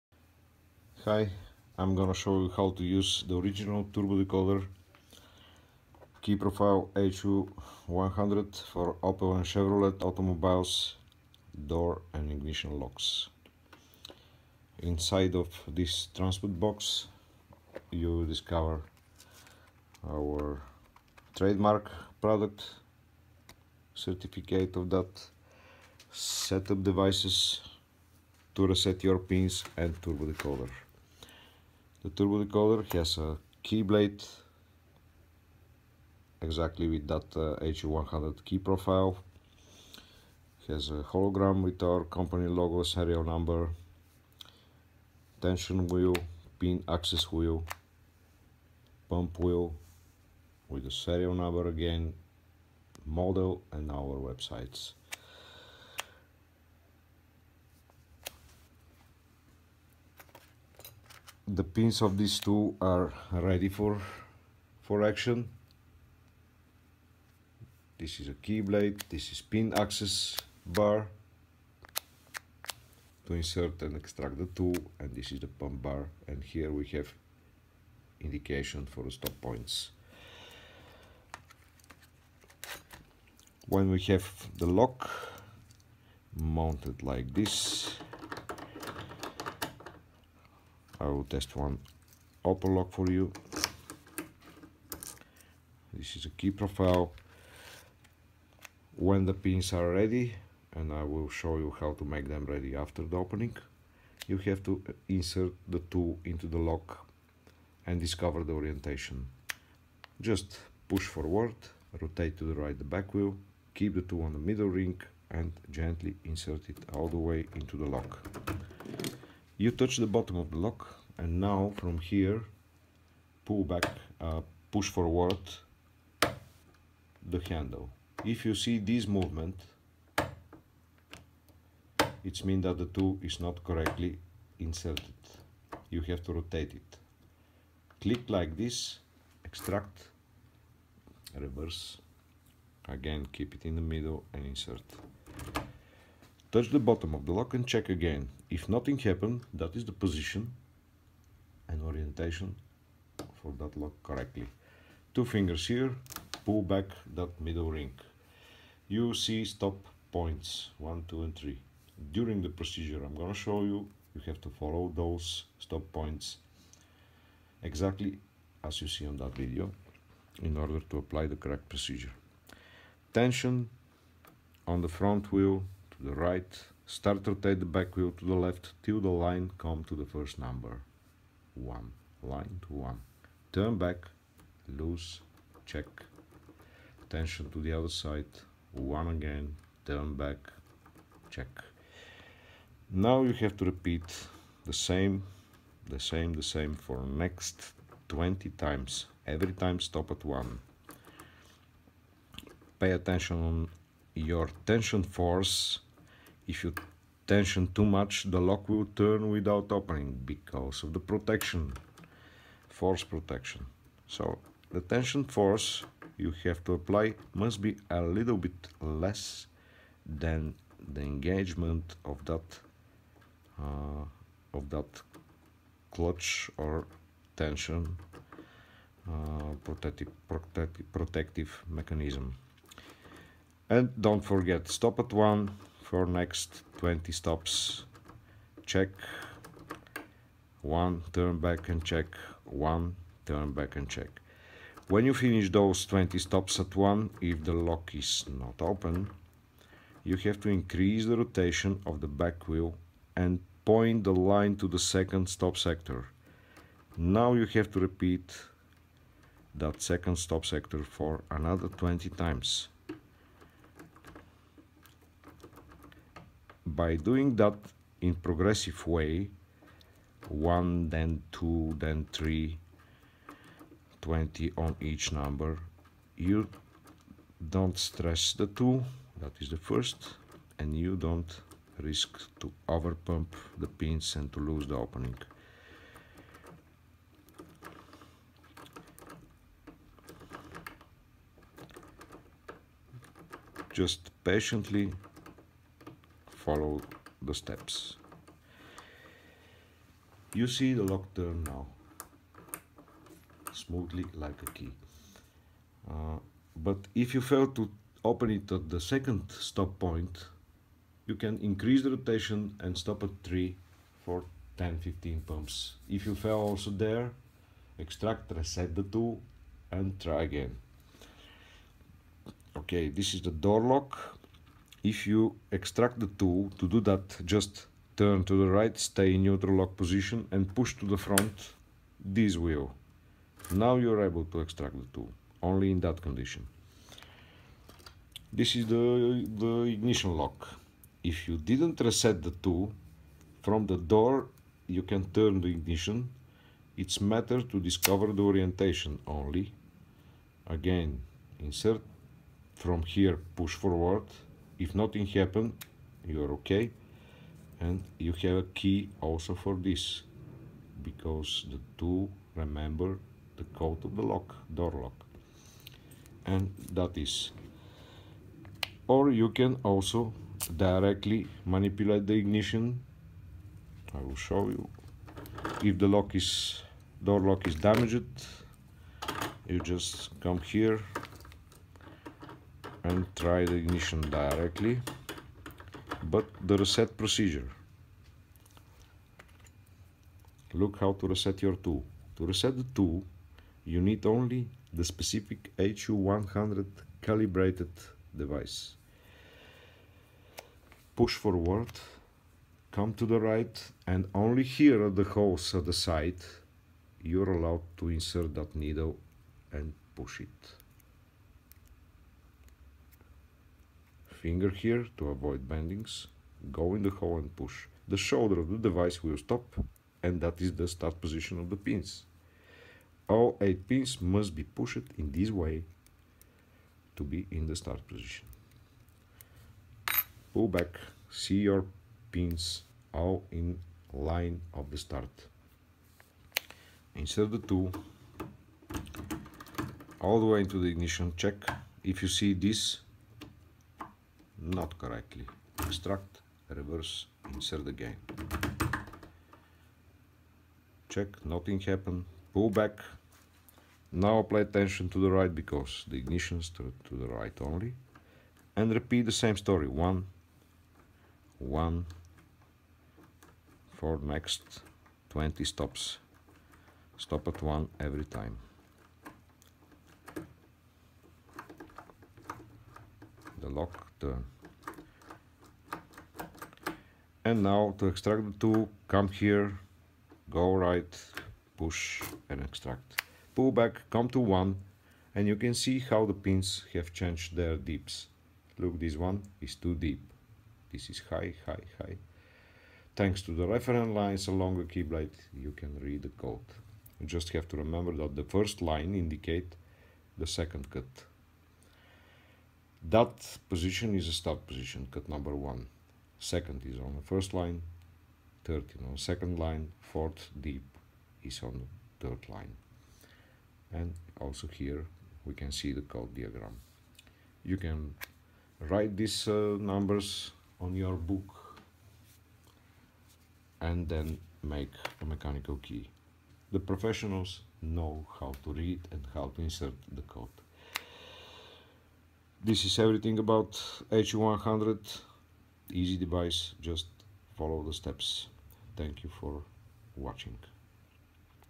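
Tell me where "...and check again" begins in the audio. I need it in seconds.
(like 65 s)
147 s.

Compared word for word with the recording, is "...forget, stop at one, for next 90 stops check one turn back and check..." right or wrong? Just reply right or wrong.
wrong.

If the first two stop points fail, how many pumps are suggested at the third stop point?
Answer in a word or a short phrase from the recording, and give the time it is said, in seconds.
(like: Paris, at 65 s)
10-15, at 314 s.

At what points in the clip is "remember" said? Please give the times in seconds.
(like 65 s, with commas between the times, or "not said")
362 s, 497 s.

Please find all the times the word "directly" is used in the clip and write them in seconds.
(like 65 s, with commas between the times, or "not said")
370 s, 384 s.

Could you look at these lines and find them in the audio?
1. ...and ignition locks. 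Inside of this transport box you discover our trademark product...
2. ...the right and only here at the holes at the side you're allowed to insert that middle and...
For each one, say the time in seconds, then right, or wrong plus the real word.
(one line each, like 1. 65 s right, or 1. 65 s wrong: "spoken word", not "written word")
1. 12 s right
2. 403 s wrong: "needle", not "middle".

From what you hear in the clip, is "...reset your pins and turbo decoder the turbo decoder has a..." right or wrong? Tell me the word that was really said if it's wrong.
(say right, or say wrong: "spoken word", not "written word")
right.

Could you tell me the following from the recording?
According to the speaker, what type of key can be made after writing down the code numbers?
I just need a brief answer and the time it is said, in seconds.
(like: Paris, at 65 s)
mechanical key, at 525 s.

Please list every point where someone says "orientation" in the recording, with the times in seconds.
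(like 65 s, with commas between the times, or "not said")
108 s, 151 s, 348 s.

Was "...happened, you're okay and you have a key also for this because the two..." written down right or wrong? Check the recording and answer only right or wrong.
right.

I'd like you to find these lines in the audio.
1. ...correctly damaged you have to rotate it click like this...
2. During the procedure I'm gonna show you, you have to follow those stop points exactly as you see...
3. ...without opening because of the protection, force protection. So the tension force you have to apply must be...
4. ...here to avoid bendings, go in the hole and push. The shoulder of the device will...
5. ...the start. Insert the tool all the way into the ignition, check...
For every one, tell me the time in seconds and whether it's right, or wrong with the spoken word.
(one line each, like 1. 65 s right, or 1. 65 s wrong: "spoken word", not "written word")
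1. 133 s wrong: "inserted", not "damaged"
2. 162 s right
3. 209 s right
4. 414 s right
5. 434 s right.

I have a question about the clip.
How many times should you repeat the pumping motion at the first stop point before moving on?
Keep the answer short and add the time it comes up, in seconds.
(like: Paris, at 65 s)
20, at 197 s.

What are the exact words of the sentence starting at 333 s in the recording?
Now you're able to extract the tool, only in that condition.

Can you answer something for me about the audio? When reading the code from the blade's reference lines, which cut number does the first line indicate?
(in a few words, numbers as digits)
second cut.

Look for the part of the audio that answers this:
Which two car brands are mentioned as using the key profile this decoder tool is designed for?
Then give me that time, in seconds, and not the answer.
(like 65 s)
9 s.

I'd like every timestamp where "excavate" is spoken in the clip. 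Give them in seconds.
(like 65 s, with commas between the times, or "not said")
not said.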